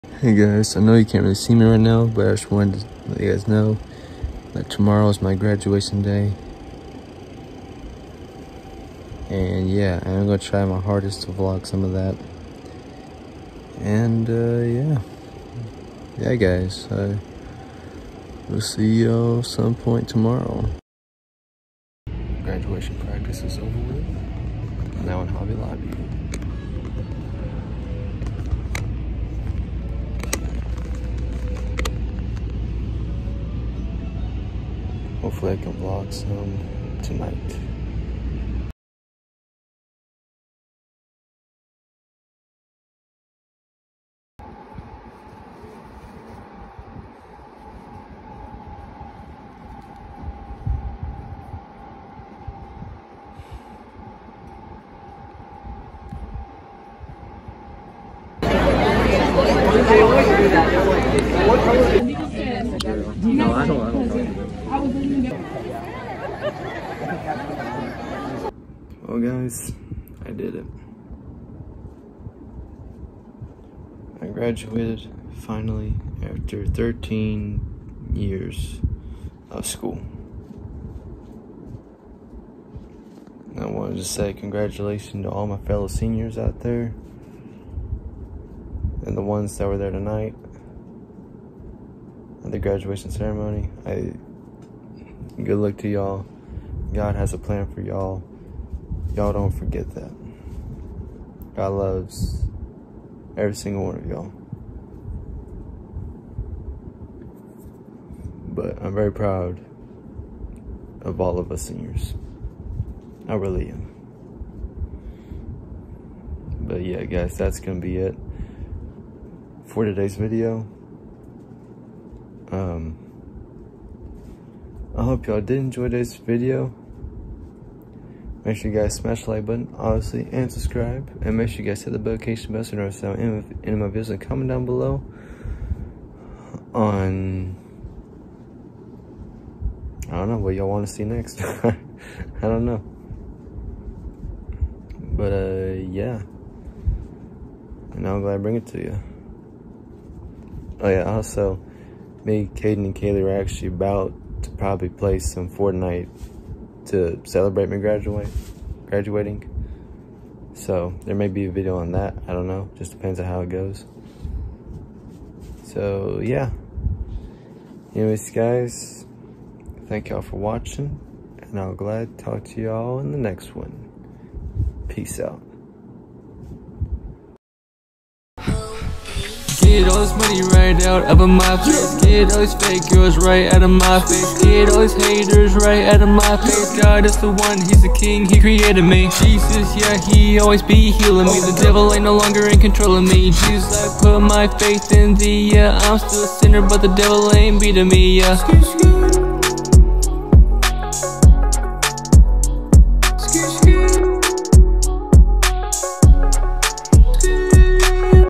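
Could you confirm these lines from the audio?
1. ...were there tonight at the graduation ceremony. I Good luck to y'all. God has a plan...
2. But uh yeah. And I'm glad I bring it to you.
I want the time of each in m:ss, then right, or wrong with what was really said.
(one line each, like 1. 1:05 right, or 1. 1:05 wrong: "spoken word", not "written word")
1. 1:29 right
2. 2:25 right.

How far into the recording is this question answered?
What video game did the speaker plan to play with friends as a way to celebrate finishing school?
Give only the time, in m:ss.
2:35.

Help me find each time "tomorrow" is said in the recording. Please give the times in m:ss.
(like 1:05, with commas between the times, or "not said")
0:04, 0:20.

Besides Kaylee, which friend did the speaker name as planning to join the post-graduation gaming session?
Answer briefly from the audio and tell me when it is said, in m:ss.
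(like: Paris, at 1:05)
Caden, at 2:32.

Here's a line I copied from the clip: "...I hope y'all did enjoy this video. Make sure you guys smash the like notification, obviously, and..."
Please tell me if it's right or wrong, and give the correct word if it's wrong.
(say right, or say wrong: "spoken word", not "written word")
wrong: "button", not "notification".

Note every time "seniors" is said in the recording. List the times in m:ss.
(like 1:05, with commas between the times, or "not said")
1:25, 1:51.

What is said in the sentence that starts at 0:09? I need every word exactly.
And yeah, I'm gonna try my hardest to vlog some of that.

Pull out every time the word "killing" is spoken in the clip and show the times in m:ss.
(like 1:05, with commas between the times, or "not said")
not said.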